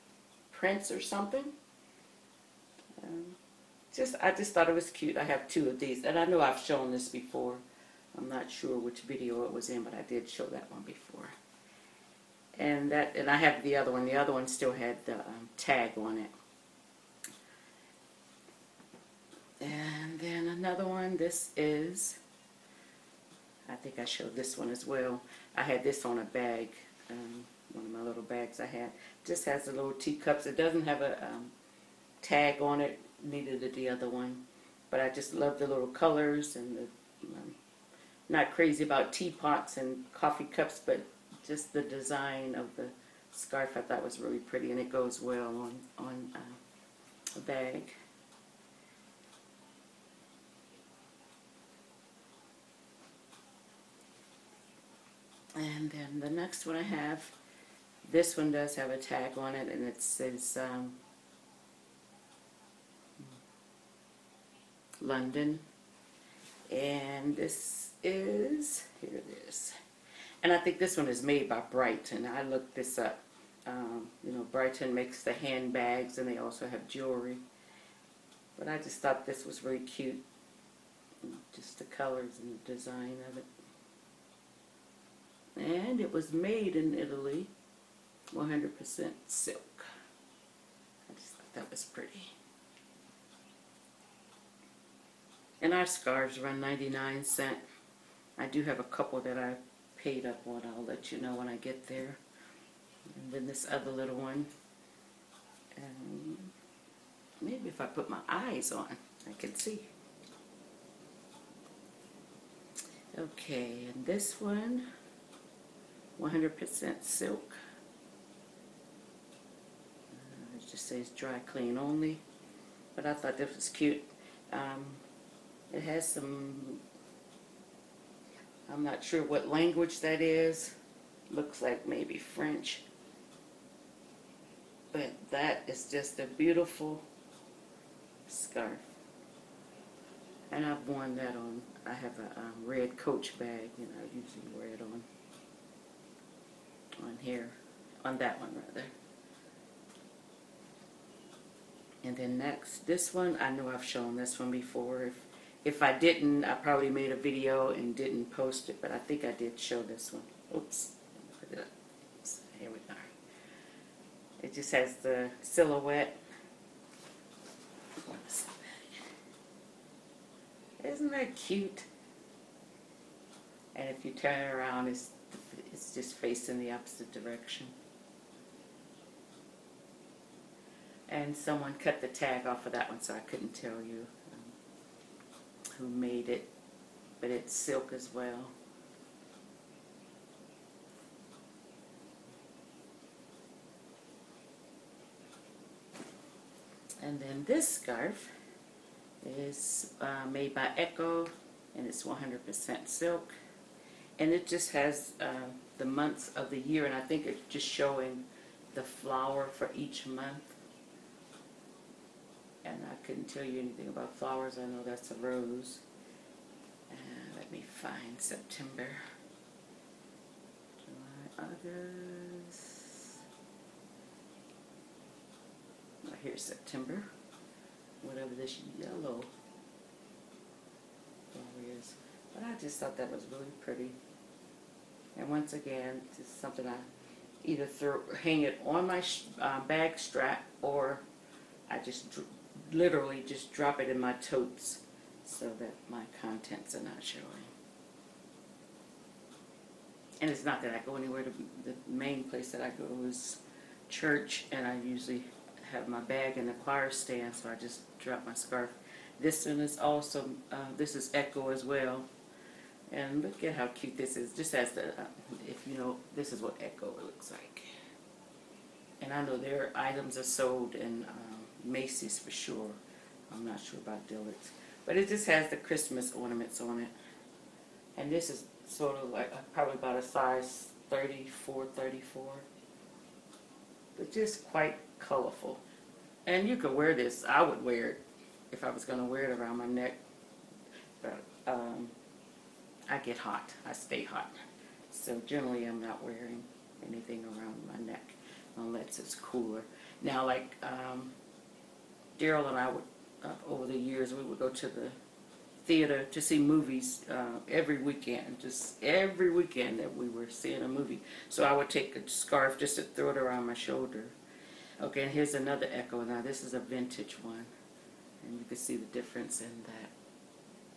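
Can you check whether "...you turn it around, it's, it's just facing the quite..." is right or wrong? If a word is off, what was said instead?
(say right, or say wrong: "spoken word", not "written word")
wrong: "opposite", not "quite".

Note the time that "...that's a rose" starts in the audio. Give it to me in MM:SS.
03:34.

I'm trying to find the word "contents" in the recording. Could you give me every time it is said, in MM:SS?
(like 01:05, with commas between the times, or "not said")
04:06.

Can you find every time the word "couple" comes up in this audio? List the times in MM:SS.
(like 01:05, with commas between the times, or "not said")
01:38.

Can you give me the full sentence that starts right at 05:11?
So I would take a scarf just to throw it around my shoulder.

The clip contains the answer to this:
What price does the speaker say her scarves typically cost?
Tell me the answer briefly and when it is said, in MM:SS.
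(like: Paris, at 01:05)
99 cents, at 01:36.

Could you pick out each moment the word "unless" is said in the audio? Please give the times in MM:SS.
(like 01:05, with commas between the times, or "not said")
04:58.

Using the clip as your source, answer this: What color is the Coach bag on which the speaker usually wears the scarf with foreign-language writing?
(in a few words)
Red.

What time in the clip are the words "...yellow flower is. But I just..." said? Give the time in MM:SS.
03:48.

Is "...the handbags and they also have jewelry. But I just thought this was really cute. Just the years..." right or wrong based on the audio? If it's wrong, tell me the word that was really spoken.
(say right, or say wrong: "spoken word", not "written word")
wrong: "colors", not "years".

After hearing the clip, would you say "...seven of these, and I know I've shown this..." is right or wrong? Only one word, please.
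wrong.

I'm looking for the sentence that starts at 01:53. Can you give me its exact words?
Okay, and this one, 100% silk.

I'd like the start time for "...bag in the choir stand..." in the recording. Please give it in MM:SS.
04:15.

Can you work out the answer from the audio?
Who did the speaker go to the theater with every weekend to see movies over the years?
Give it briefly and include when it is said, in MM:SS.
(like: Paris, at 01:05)
Daryl, at 05:02.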